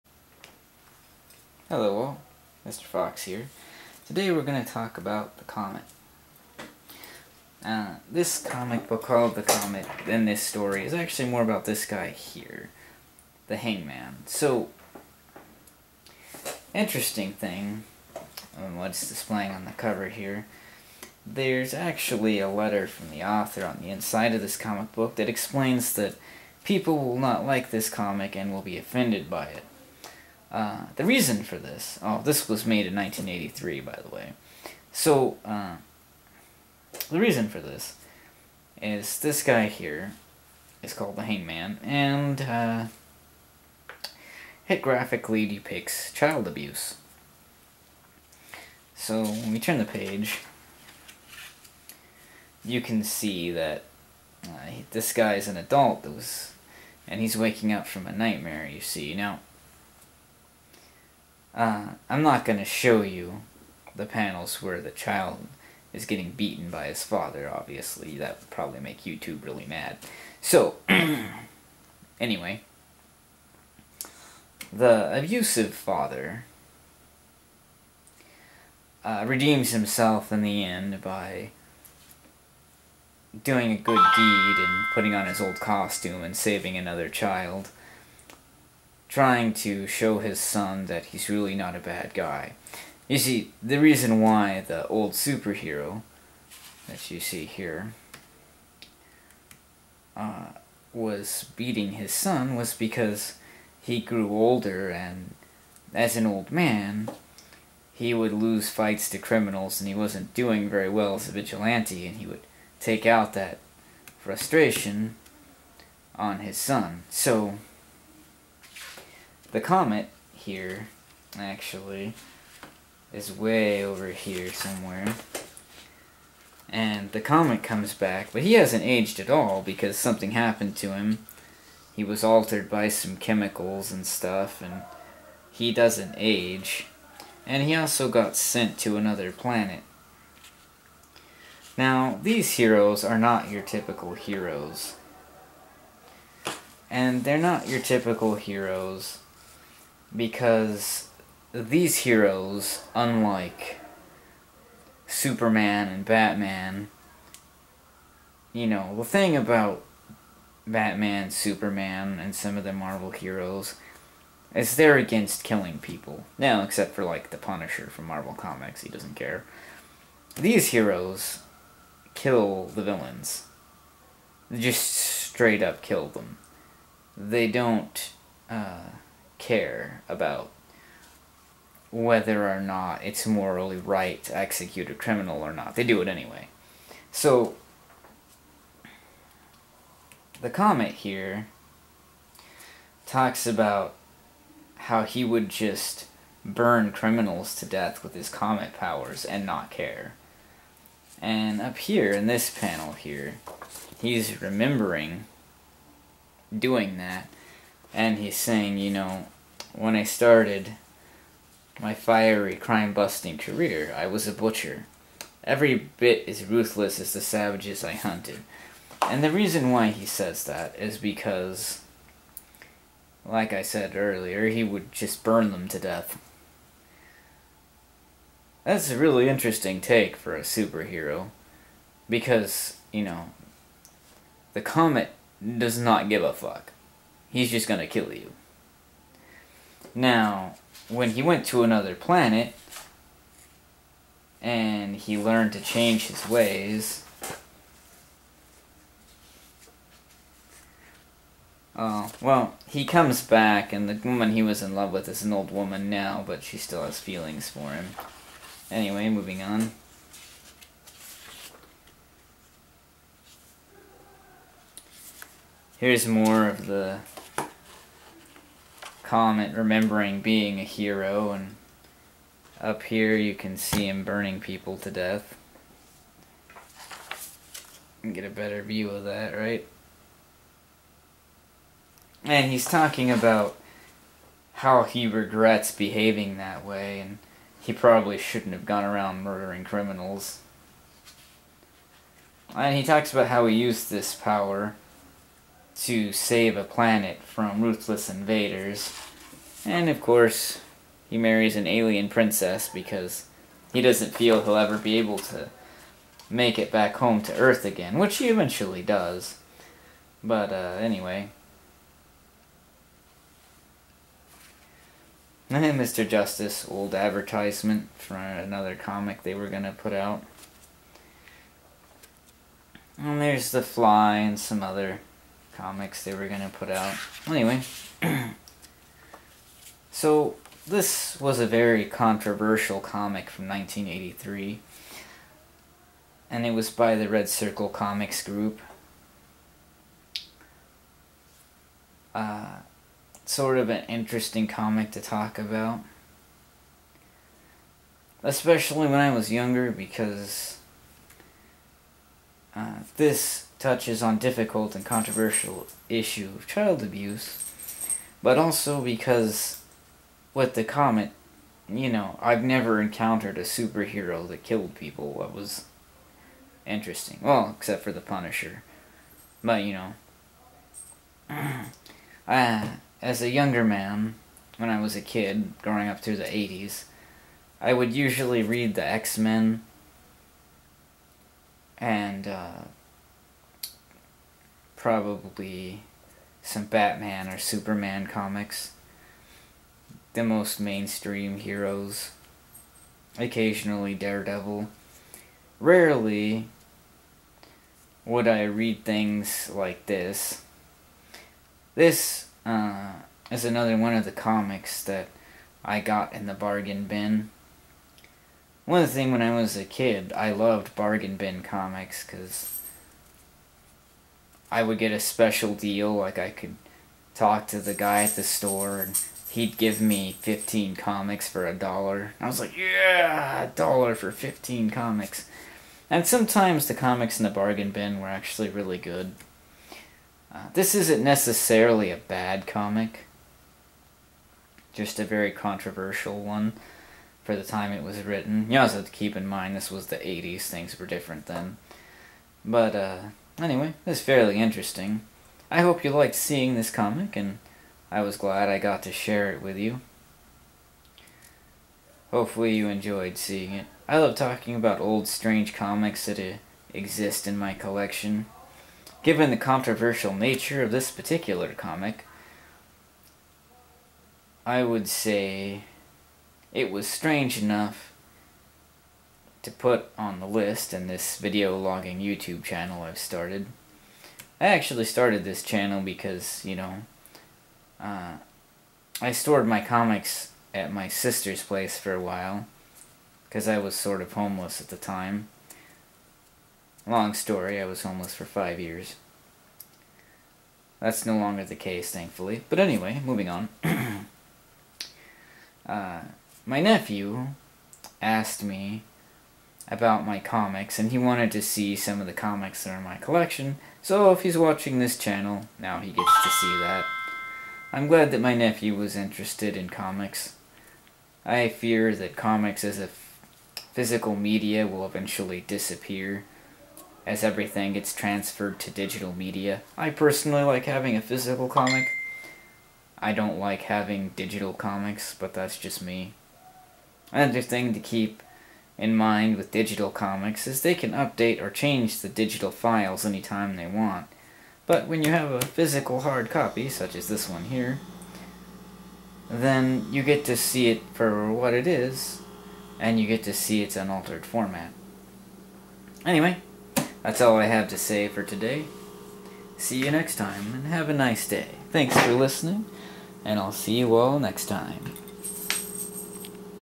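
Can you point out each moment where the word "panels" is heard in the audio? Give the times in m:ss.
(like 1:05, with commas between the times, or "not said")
1:04, 3:22.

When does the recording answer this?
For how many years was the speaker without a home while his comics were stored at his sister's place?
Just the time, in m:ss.
8:08.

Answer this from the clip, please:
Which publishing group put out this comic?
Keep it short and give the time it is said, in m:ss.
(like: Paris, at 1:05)
Red Circle Comics, at 5:37.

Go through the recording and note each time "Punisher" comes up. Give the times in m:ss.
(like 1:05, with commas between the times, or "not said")
2:47, 6:08.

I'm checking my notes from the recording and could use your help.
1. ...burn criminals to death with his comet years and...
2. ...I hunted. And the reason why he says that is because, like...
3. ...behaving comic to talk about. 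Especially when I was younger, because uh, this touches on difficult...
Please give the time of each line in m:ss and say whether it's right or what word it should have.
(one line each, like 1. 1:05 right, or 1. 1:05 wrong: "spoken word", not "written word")
1. 3:16 wrong: "powers", not "years"
2. 3:37 right
3. 5:43 wrong: "interesting", not "behaving".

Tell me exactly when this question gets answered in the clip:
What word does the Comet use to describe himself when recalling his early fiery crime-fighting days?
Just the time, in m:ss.
3:34.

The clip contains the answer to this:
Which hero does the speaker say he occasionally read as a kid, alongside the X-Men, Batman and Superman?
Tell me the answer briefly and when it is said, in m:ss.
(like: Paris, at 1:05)
Daredevil, at 6:33.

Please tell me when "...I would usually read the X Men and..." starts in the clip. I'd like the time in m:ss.
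6:17.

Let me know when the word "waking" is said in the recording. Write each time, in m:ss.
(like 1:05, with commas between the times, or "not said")
0:57.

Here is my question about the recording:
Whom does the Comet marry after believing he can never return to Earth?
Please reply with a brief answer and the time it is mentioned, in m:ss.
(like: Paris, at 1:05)
An alien princess, at 5:01.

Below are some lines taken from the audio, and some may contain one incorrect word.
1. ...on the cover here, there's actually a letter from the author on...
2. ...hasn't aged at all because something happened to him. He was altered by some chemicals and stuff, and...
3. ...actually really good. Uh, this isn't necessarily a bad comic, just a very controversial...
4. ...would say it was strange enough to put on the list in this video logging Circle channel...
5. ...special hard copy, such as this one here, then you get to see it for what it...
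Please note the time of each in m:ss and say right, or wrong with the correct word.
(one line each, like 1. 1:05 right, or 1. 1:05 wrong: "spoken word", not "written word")
1. 0:19 right
2. 2:08 right
3. 7:08 right
4. 7:44 wrong: "YouTube", not "Circle"
5. 8:55 wrong: "physical", not "special".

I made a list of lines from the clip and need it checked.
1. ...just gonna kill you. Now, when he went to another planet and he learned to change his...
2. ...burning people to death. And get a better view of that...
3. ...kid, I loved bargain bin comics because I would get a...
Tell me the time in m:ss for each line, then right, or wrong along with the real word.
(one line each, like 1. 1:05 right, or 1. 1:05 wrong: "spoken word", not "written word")
1. 3:57 right
2. 4:34 right
3. 6:49 right.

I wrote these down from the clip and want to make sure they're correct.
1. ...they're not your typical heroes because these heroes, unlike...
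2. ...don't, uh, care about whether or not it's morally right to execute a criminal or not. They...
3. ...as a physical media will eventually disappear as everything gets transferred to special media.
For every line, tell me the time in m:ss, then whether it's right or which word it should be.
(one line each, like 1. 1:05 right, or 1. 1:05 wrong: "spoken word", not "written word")
1. 2:27 right
2. 2:57 right
3. 8:32 wrong: "digital", not "special".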